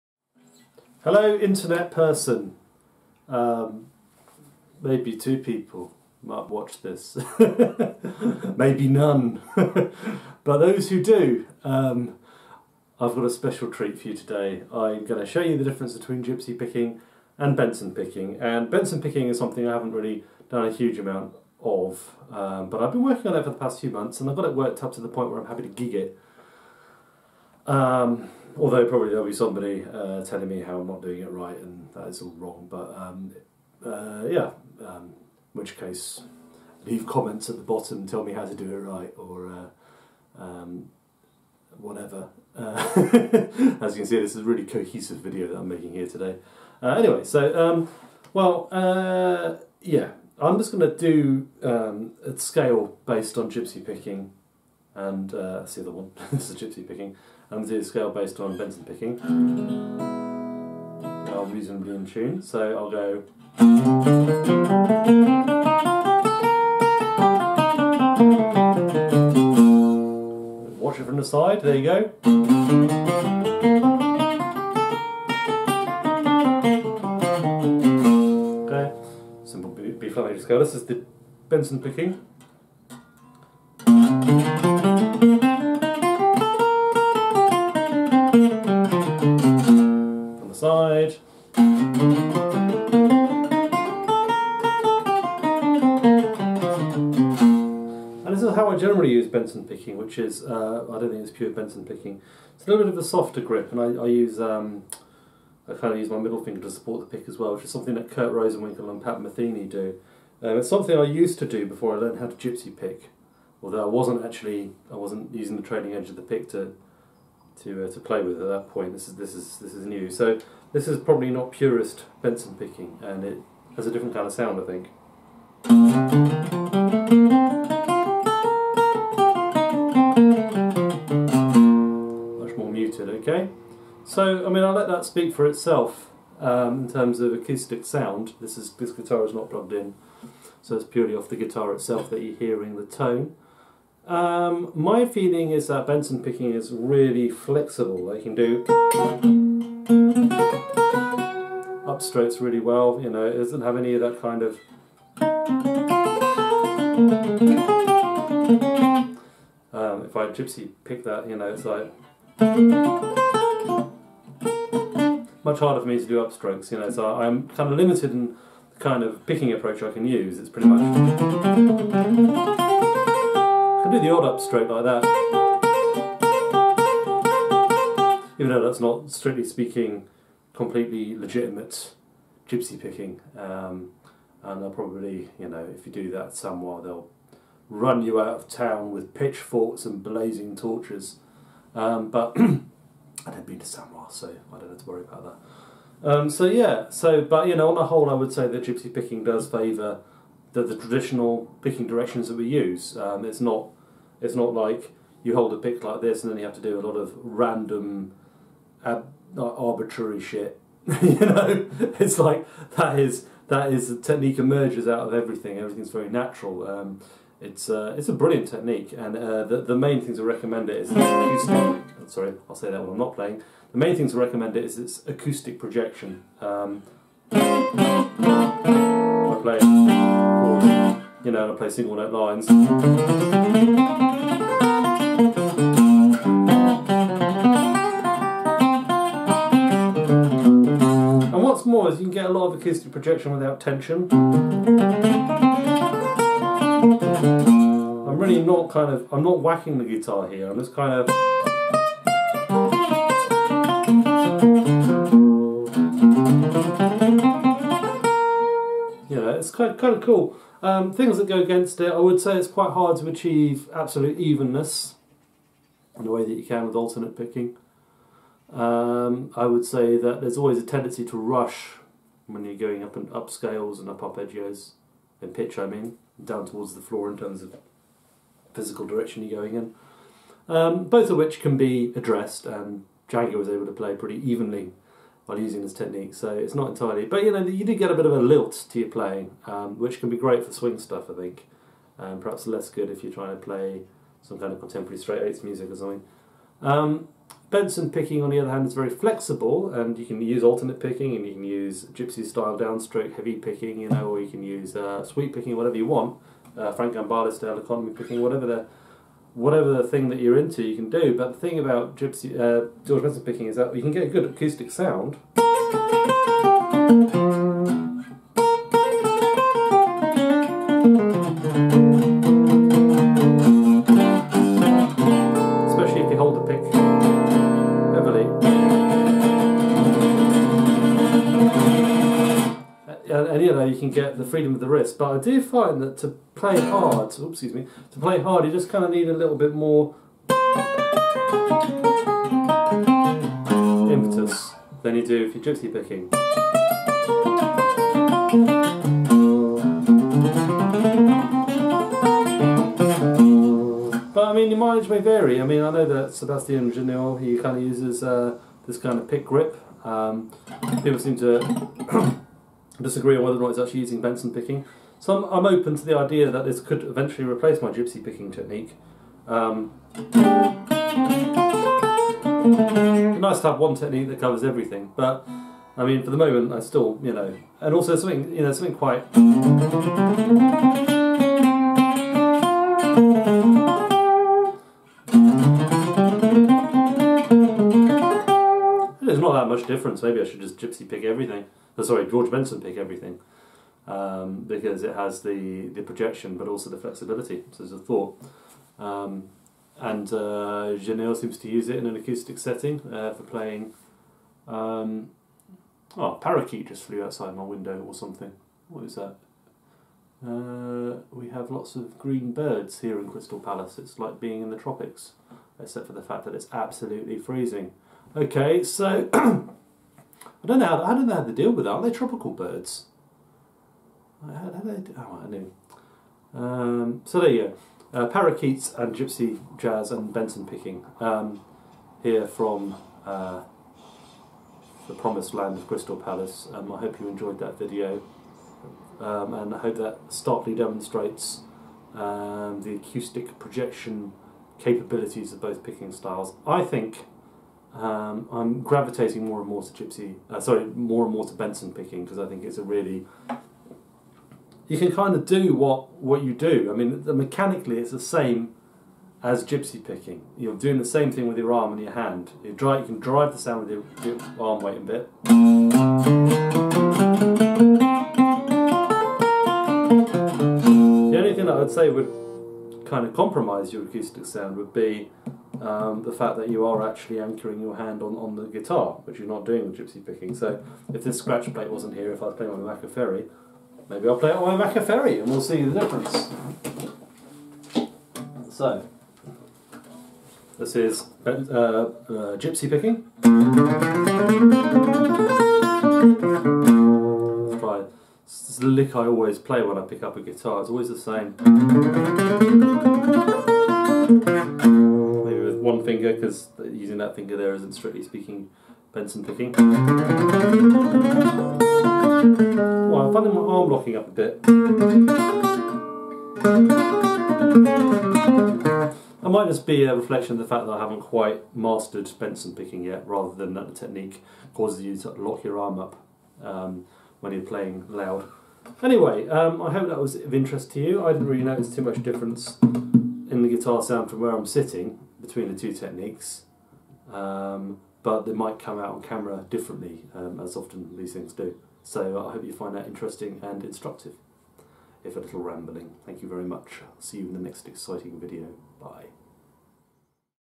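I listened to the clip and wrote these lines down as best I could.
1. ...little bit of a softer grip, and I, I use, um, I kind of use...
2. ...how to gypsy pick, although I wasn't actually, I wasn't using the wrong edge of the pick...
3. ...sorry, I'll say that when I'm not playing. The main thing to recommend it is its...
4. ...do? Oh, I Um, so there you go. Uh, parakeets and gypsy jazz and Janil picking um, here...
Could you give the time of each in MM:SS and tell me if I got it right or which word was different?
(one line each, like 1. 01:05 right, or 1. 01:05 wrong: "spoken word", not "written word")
1. 01:42 right
2. 01:52 wrong: "trailing", not "wrong"
3. 03:42 right
4. 07:04 wrong: "Benson", not "Janil".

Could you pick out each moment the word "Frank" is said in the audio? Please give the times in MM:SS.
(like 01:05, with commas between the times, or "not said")
05:06.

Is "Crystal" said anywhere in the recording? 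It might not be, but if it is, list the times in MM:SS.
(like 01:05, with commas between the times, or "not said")
06:53, 07:15.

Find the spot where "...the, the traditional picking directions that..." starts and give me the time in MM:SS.
03:20.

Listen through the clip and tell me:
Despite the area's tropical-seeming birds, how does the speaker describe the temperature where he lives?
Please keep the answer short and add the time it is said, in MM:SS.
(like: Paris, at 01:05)
absolutely freezing, at 06:56.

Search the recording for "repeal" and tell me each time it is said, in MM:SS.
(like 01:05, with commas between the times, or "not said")
not said.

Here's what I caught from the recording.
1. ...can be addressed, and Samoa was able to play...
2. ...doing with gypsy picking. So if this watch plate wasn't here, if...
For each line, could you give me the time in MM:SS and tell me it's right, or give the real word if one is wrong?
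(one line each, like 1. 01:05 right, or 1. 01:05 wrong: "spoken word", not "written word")
1. 04:41 wrong: "Django", not "Samoa"
2. 07:59 wrong: "scratch", not "watch".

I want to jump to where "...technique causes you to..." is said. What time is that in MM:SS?
08:43.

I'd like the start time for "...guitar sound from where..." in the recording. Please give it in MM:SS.
08:53.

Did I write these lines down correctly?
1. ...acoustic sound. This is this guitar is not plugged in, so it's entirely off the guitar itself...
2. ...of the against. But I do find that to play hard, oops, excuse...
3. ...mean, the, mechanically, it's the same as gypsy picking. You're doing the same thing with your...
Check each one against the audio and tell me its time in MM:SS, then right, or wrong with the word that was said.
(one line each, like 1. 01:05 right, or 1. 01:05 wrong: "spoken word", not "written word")
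1. 02:17 wrong: "purely", not "entirely"
2. 05:34 wrong: "wrist", not "against"
3. 07:36 right.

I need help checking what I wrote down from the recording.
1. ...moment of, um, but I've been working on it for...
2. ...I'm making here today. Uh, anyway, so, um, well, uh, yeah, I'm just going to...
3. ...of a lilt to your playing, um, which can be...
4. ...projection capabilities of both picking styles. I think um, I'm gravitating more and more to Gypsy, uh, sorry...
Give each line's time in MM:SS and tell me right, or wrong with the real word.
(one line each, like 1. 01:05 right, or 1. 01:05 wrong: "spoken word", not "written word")
1. 00:20 wrong: "amount", not "moment"
2. 00:45 right
3. 04:48 right
4. 07:23 right.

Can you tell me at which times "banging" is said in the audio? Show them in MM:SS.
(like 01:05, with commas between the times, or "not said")
not said.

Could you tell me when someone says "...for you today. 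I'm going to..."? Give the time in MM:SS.
00:13.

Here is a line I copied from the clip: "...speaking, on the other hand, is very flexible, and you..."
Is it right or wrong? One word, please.
wrong.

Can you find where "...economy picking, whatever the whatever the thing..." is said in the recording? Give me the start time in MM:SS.
05:07.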